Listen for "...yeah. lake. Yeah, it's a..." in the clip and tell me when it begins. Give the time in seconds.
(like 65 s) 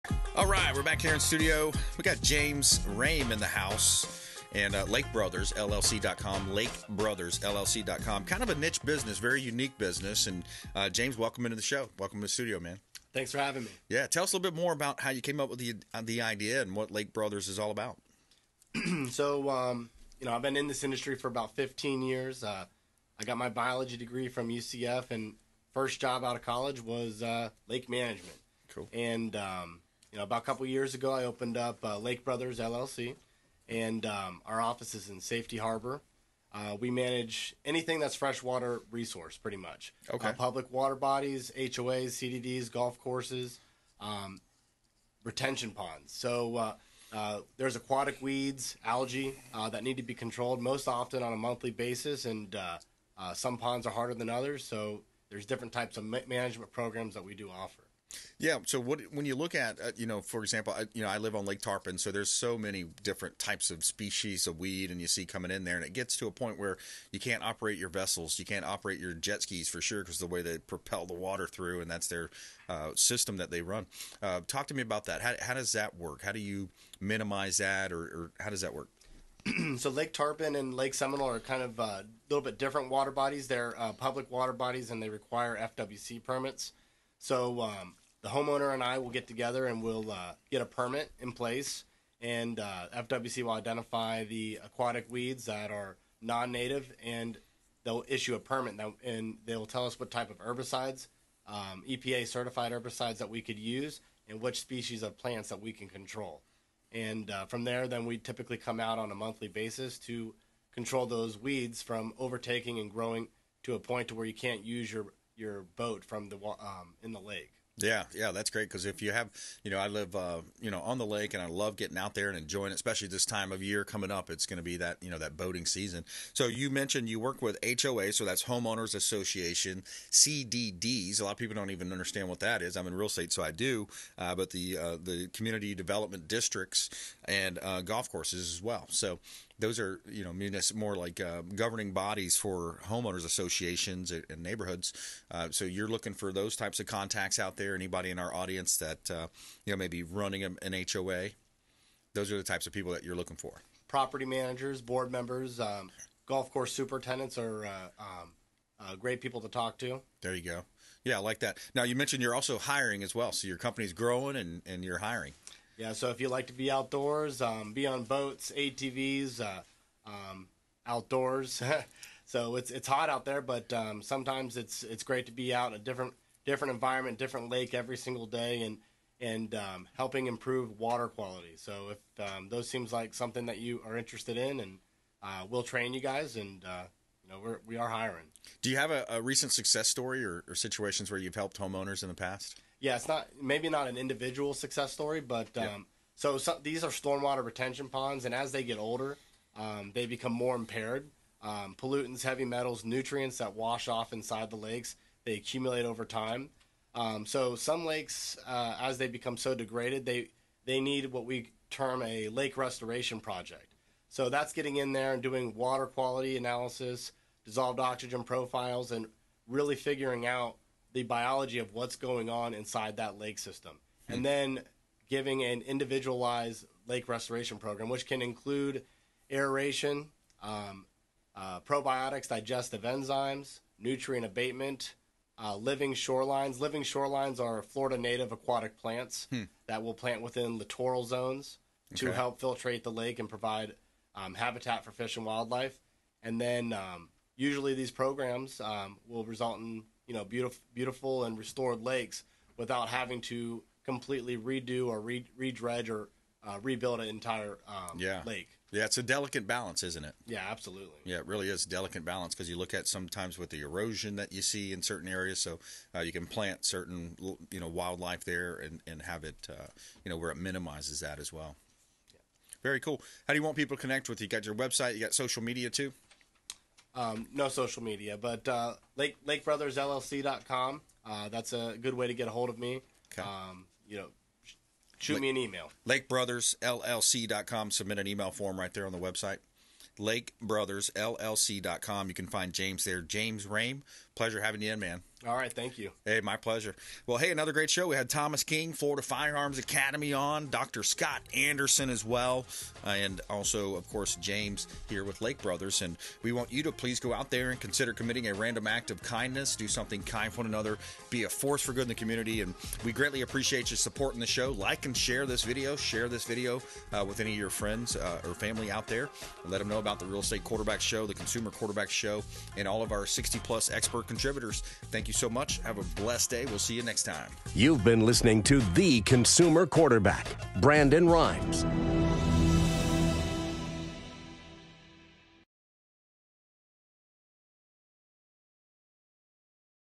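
257 s.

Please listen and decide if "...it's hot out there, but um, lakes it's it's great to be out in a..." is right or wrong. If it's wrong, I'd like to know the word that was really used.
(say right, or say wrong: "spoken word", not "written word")
wrong: "sometimes", not "lakes".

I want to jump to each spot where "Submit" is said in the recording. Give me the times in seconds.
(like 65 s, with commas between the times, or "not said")
287 s.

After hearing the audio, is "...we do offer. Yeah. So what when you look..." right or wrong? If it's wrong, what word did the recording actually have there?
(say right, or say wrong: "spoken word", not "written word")
right.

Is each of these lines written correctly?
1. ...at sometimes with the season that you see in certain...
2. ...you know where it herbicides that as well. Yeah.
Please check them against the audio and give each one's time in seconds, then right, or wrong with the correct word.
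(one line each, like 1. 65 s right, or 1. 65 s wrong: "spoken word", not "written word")
1. 262 s wrong: "erosion", not "season"
2. 270 s wrong: "minimizes", not "herbicides".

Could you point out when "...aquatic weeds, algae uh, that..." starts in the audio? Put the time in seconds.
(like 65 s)
47 s.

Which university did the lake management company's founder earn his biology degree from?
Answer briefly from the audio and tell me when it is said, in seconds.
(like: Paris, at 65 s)
UCF, at 24 s.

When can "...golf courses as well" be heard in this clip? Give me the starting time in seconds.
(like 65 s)
137 s.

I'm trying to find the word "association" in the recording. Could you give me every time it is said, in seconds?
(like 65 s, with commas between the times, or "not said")
128 s, 143 s.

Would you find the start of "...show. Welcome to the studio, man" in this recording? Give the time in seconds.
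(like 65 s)
11 s.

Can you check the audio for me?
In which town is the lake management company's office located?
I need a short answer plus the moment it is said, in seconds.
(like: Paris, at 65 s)
Safety Harbor, at 35 s.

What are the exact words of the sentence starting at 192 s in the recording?
Yeah, it's not maybe not an individual success story, but um, yeah.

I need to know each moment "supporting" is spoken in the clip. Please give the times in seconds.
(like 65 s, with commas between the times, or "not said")
313 s.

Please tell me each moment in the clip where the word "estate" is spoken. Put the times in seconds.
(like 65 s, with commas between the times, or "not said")
133 s, 320 s.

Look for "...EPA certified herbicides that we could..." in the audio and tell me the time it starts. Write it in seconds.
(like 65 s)
101 s.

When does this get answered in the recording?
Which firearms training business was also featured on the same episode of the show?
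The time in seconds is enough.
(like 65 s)
298 s.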